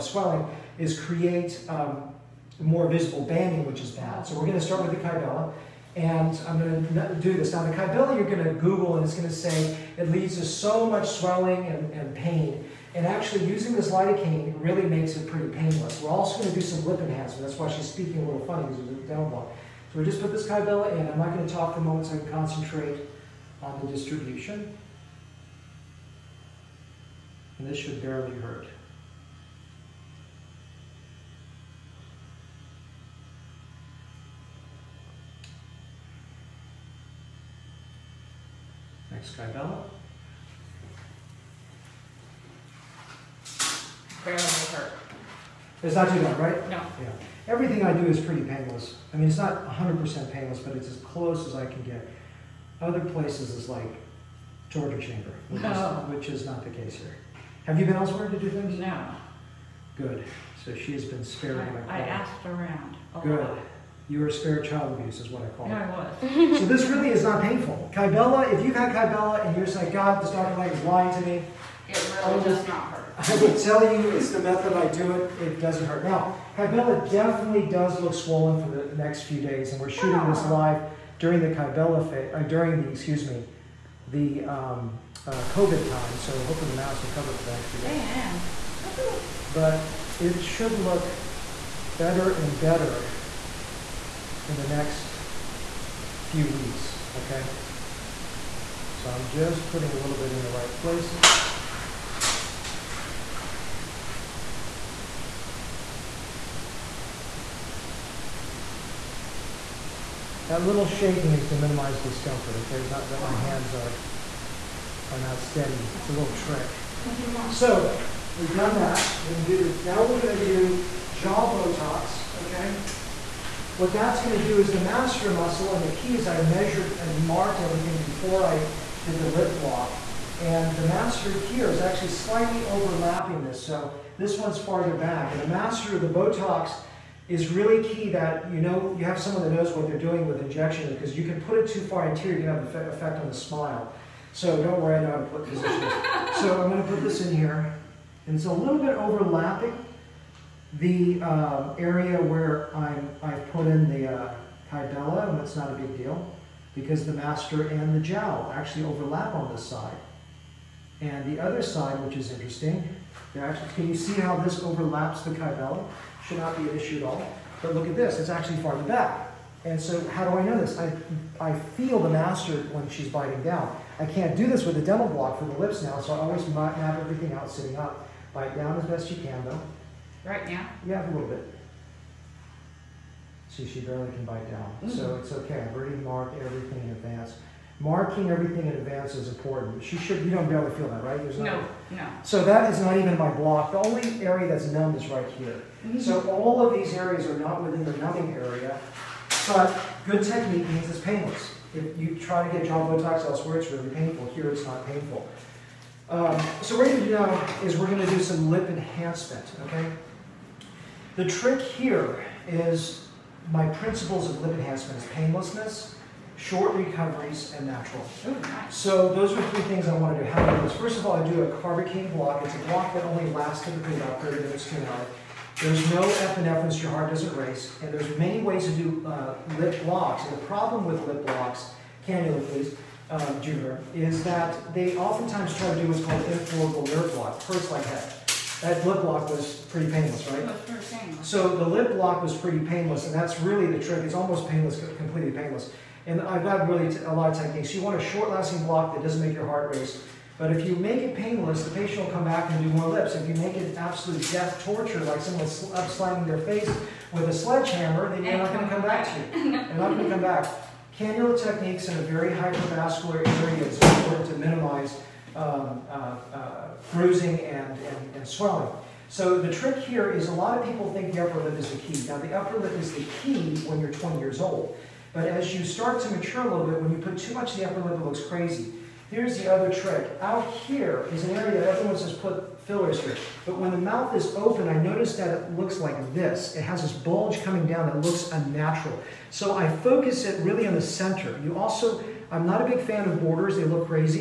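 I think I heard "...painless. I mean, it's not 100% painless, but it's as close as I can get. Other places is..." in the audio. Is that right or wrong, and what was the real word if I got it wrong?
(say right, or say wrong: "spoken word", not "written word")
right.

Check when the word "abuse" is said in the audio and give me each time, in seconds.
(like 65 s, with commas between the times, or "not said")
64 s.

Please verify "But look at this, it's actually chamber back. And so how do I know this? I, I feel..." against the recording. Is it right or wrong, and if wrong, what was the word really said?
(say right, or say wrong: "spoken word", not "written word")
wrong: "farther", not "chamber".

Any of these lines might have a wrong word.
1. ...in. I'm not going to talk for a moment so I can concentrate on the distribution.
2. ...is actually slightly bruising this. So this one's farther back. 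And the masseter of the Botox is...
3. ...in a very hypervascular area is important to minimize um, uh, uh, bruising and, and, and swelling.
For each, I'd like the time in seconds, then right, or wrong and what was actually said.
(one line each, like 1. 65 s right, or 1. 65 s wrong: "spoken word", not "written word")
1. 20 s right
2. 131 s wrong: "overlapping", not "bruising"
3. 261 s right.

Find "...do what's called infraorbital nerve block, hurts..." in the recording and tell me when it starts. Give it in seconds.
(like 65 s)
235 s.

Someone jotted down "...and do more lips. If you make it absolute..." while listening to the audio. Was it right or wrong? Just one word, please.
right.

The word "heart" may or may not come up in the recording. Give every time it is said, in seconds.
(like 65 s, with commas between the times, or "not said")
226 s, 249 s.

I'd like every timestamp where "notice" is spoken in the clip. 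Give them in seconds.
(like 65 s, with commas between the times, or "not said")
284 s.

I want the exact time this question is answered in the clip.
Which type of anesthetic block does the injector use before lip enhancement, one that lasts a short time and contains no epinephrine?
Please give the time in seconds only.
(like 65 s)
221 s.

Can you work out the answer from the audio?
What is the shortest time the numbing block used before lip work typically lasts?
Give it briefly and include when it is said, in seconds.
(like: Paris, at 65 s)
30 minutes, at 224 s.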